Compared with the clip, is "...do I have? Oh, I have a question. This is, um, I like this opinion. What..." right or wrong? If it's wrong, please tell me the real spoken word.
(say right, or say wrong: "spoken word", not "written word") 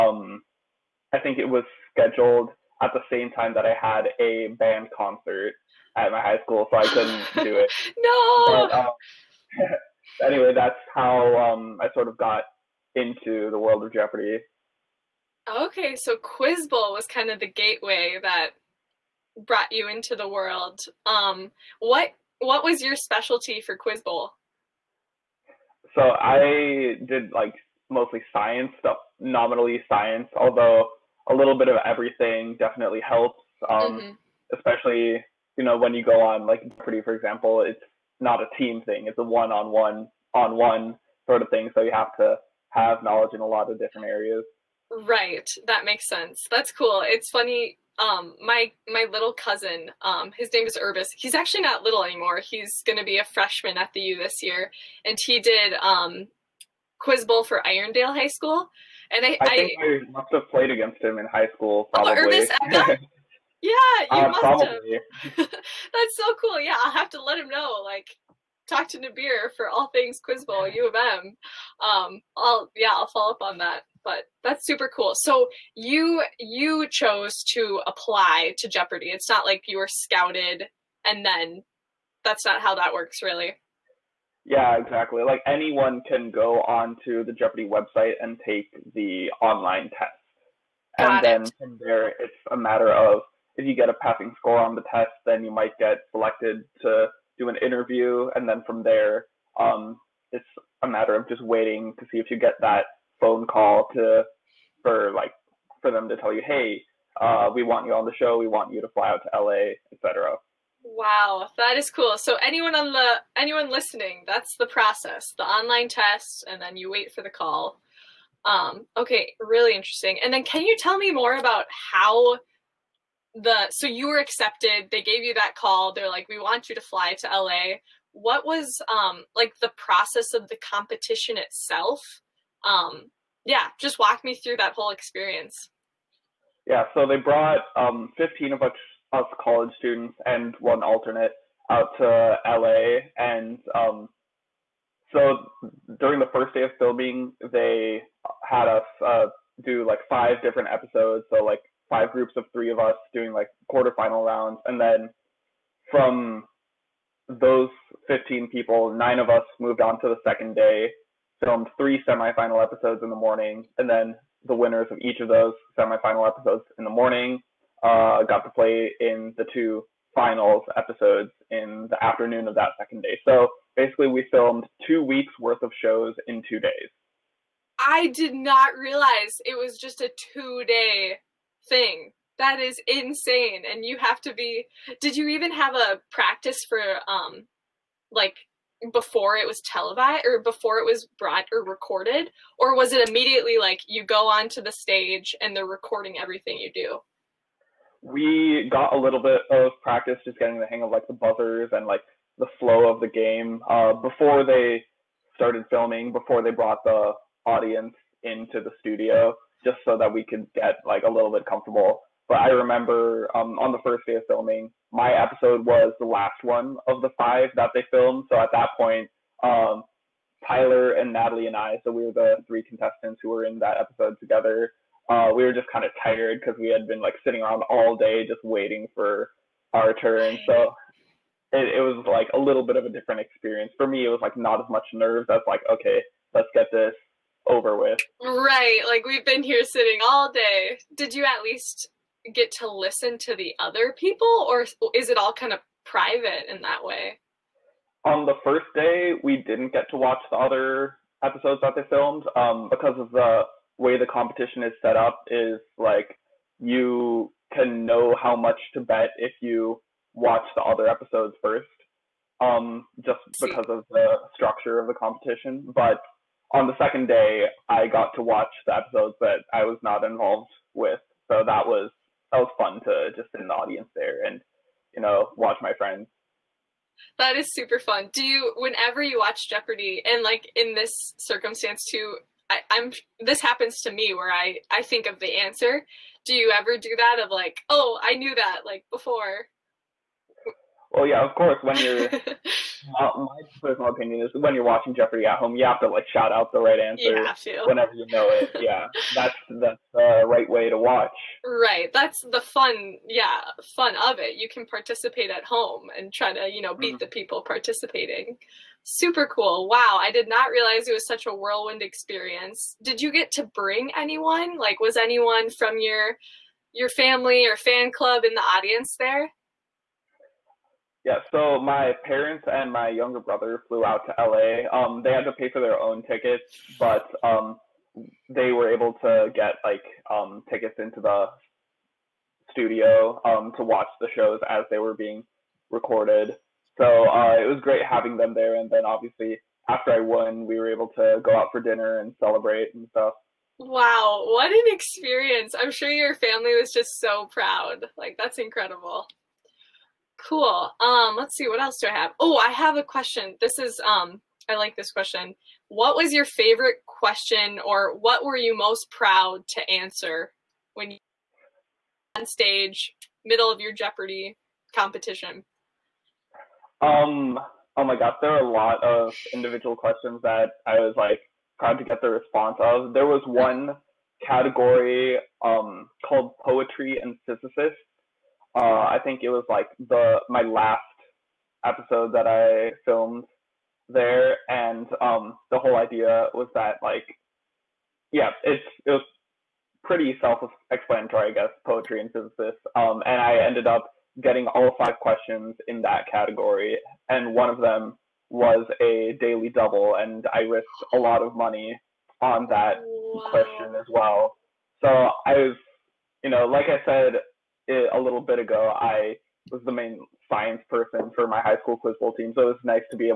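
wrong: "question", not "opinion".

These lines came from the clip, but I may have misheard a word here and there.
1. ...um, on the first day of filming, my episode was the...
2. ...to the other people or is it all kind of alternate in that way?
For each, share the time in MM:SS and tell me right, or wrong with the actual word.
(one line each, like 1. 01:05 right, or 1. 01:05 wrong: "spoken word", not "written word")
1. 03:33 right
2. 04:03 wrong: "private", not "alternate".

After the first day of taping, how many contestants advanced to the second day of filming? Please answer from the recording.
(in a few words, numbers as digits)
9.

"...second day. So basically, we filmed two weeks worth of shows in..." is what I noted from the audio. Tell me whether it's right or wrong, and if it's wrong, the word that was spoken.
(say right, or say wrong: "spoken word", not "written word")
right.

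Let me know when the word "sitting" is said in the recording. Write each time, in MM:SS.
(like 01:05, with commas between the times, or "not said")
03:47, 03:59.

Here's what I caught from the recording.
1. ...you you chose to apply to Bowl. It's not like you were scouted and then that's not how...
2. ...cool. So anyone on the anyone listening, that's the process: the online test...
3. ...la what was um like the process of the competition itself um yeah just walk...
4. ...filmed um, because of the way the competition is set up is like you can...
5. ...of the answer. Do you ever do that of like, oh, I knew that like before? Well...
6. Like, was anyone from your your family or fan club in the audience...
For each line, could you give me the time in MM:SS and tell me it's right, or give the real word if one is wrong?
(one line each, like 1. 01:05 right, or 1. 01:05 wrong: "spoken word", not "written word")
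1. 01:15 wrong: "Jeopardy", not "Bowl"
2. 01:51 right
3. 02:07 right
4. 04:11 right
5. 04:45 right
6. 05:14 right.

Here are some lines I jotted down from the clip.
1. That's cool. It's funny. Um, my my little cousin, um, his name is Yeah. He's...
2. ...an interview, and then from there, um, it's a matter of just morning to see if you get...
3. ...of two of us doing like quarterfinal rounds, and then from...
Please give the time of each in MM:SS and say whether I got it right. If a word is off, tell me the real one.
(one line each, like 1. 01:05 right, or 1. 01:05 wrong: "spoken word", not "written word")
1. 00:46 wrong: "Urbis", not "Yeah"
2. 01:37 wrong: "waiting", not "morning"
3. 02:32 wrong: "three", not "two".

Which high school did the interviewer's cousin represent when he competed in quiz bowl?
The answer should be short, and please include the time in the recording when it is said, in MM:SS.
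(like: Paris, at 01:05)
Irondale High School, at 00:57.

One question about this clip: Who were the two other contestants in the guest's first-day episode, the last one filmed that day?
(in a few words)
Tyler and Natalie.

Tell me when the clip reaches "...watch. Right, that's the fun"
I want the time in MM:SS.
05:00.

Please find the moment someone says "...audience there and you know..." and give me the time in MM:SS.
04:33.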